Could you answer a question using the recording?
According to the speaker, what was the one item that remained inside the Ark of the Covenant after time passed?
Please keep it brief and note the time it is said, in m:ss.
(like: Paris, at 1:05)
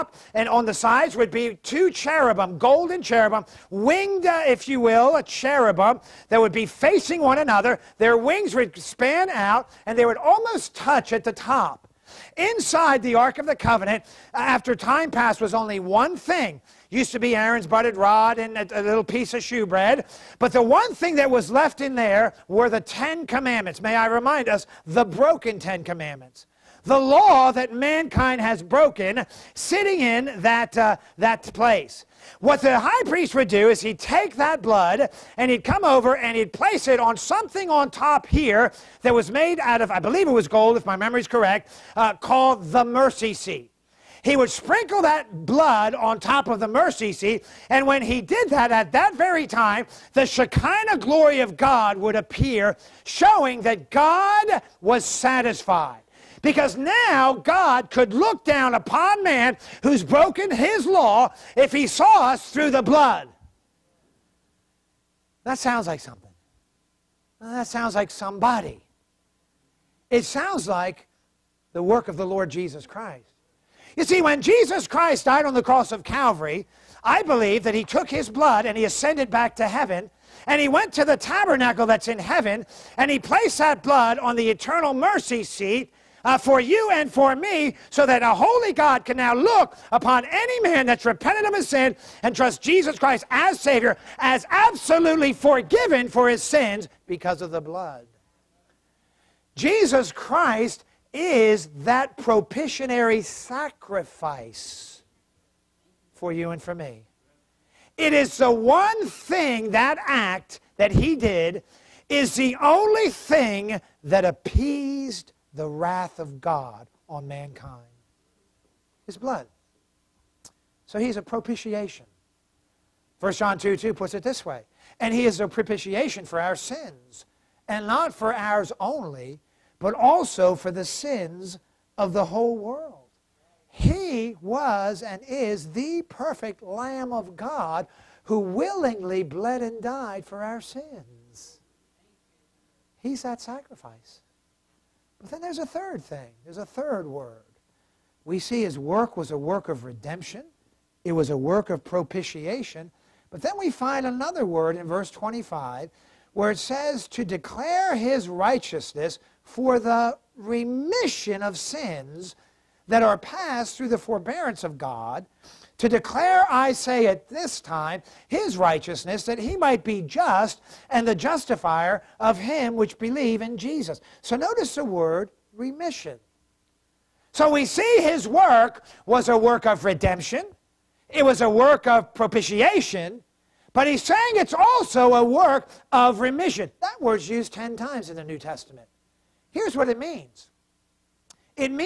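The Ten Commandments, at 0:22.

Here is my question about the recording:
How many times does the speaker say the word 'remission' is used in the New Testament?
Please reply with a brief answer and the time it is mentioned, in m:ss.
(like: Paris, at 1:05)
10, at 3:07.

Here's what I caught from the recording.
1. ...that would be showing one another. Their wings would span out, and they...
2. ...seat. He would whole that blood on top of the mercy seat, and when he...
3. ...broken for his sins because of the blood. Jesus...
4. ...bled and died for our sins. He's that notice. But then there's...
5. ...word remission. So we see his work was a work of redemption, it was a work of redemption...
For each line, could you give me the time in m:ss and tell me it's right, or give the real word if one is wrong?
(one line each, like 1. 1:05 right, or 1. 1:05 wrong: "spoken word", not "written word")
1. 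0:06 wrong: "facing", not "showing"
2. 0:43 wrong: "sprinkle", not "whole"
3. 1:35 wrong: "forgiven", not "broken"
4. 2:19 wrong: "sacrifice", not "notice"
5. 2:54 wrong: "propitiation", not "redemption".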